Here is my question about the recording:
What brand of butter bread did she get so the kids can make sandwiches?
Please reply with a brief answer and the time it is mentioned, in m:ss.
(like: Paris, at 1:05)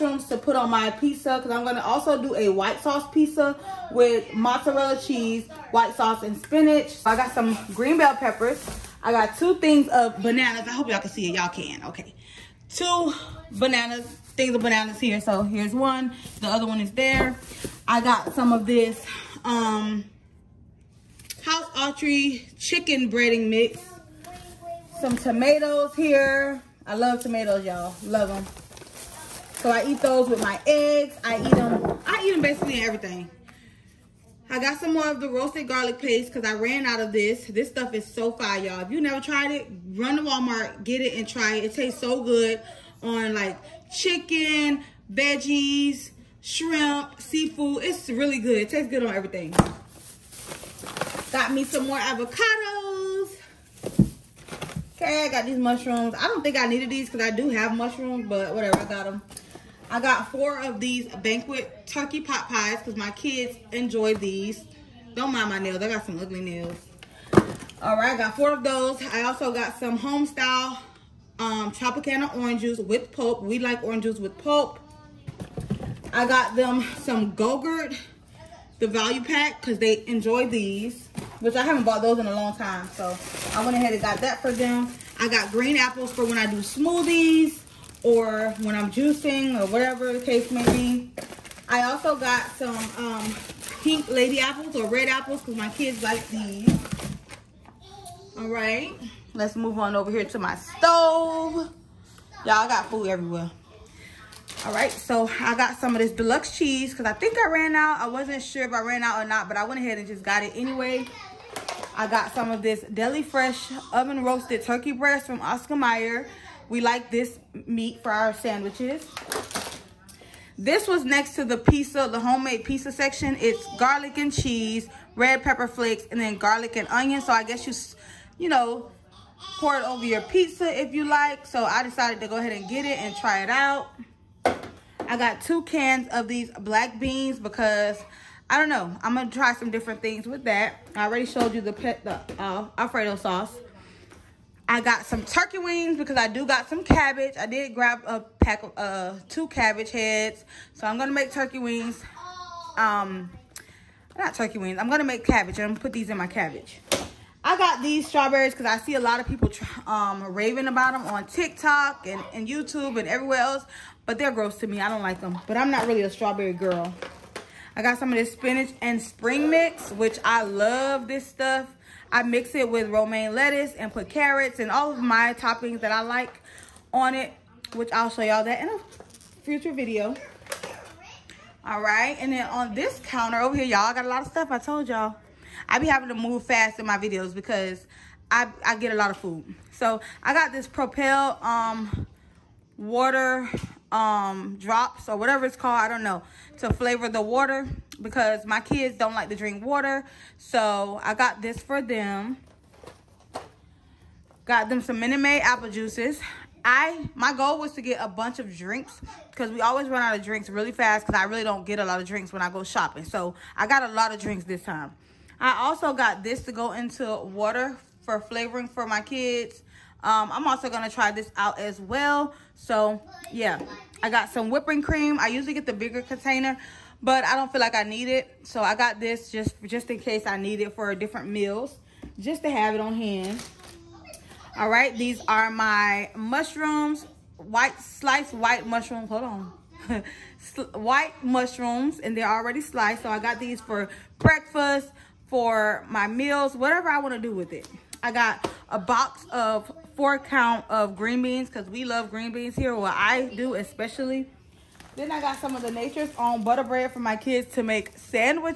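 Nature's Own, at 4:15.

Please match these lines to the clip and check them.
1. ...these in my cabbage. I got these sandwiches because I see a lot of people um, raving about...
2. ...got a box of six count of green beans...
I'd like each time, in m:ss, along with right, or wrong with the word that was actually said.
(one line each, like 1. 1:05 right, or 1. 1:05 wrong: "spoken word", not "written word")
1. 2:35 wrong: "strawberries", not "sandwiches"
2. 4:08 wrong: "four", not "six".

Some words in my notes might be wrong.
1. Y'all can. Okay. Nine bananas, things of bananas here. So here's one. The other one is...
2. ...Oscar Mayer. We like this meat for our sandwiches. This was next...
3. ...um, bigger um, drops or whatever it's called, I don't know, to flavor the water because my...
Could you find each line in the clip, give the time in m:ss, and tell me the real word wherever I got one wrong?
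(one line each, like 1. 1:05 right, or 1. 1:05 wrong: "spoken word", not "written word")
1. 0:11 wrong: "Two", not "Nine"
2. 1:55 right
3. 3:11 wrong: "water", not "bigger".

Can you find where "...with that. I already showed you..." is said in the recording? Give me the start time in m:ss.
2:20.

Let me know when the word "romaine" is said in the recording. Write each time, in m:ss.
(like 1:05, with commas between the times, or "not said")
2:52.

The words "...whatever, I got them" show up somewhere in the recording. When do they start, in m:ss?
0:58.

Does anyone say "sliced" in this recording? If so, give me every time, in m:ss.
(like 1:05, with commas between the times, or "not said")
3:57, 4:02.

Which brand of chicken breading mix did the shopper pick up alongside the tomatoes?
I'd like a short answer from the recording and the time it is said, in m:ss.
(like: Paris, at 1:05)
House Autry, at 0:21.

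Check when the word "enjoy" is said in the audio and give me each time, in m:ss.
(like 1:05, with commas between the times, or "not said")
1:03, 1:20.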